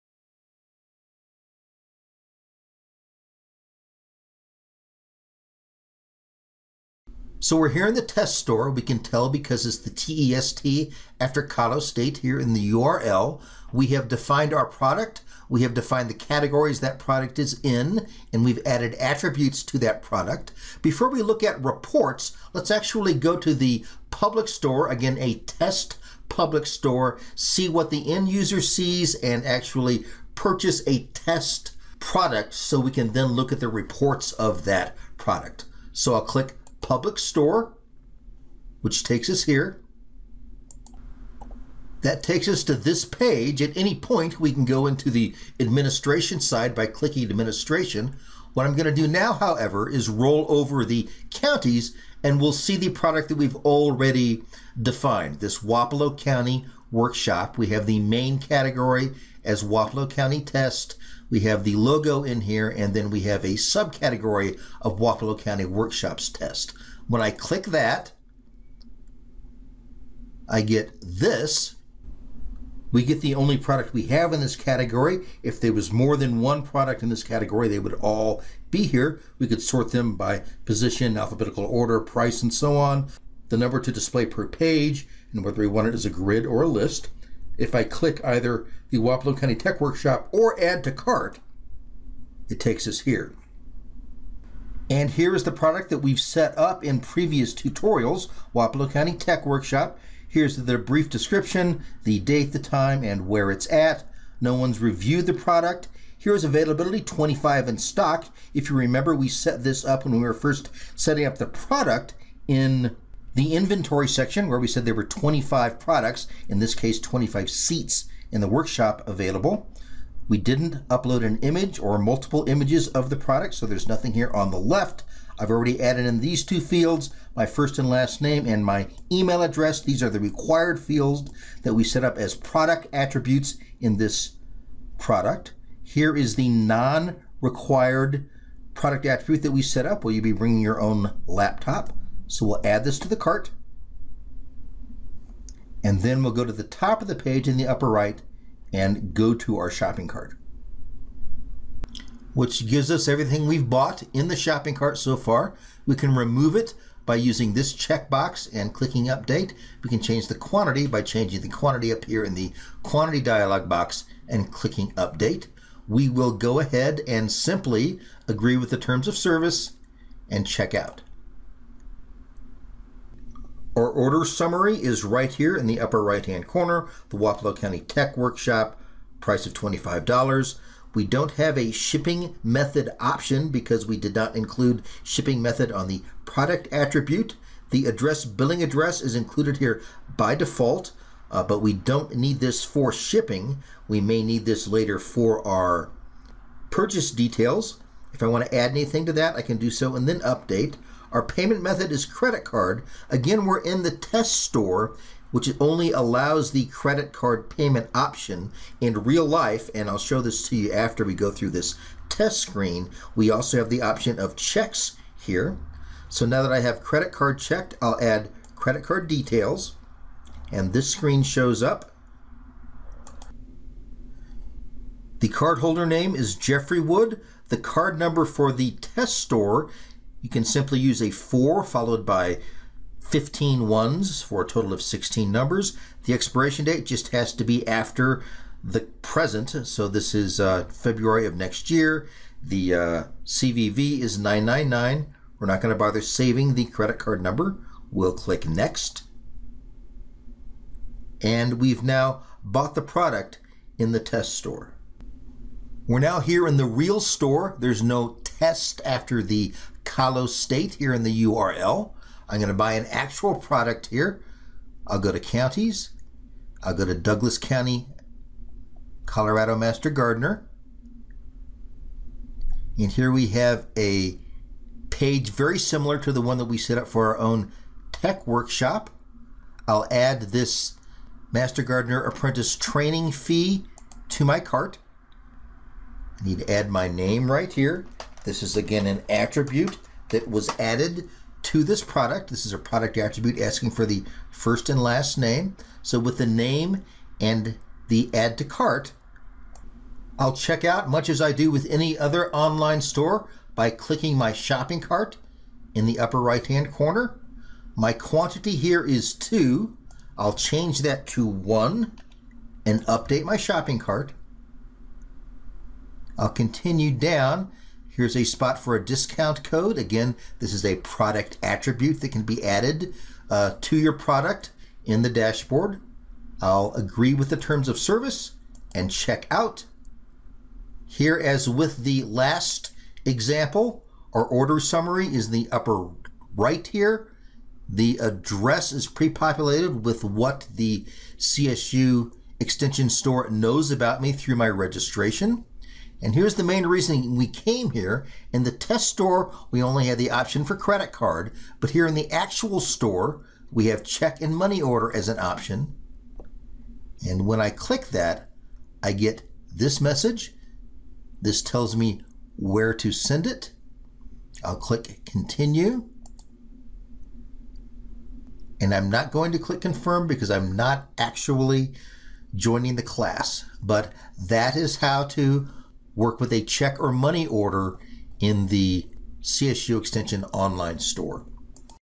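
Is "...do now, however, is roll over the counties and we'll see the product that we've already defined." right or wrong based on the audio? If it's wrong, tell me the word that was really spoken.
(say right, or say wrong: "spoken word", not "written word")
right.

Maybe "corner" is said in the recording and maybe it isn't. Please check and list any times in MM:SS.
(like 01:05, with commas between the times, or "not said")
02:56, 05:06.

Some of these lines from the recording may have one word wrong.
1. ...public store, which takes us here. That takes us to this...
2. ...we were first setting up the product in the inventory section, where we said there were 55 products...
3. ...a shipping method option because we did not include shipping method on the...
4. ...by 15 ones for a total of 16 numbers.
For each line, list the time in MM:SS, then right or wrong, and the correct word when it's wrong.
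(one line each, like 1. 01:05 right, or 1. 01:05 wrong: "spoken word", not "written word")
1. 00:36 right
2. 01:50 wrong: "25", not "55"
3. 03:01 right
4. 03:52 right.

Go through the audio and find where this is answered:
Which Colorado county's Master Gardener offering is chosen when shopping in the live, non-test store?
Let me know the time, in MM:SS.
04:26.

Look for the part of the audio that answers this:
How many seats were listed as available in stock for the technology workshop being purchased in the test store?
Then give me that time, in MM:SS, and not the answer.
01:47.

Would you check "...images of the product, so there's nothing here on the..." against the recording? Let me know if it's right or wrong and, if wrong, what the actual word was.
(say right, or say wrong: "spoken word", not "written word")
right.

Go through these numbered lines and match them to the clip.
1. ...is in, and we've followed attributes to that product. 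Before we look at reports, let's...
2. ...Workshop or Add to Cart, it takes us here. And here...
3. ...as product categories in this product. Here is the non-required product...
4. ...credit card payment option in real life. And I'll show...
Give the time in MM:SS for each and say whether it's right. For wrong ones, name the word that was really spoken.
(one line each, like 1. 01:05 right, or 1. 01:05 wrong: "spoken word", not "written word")
1. 00:17 wrong: "added", not "followed"
2. 01:29 right
3. 02:12 wrong: "attributes", not "categories"
4. 03:26 right.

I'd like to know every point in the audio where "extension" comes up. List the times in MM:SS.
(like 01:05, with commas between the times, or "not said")
05:42, 06:19.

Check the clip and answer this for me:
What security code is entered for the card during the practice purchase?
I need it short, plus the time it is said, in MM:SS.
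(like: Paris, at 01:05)
999, at 04:04.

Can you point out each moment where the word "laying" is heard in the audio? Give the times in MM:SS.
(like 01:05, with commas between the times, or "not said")
not said.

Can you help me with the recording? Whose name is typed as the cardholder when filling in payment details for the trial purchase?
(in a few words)
Jeffrey Wood.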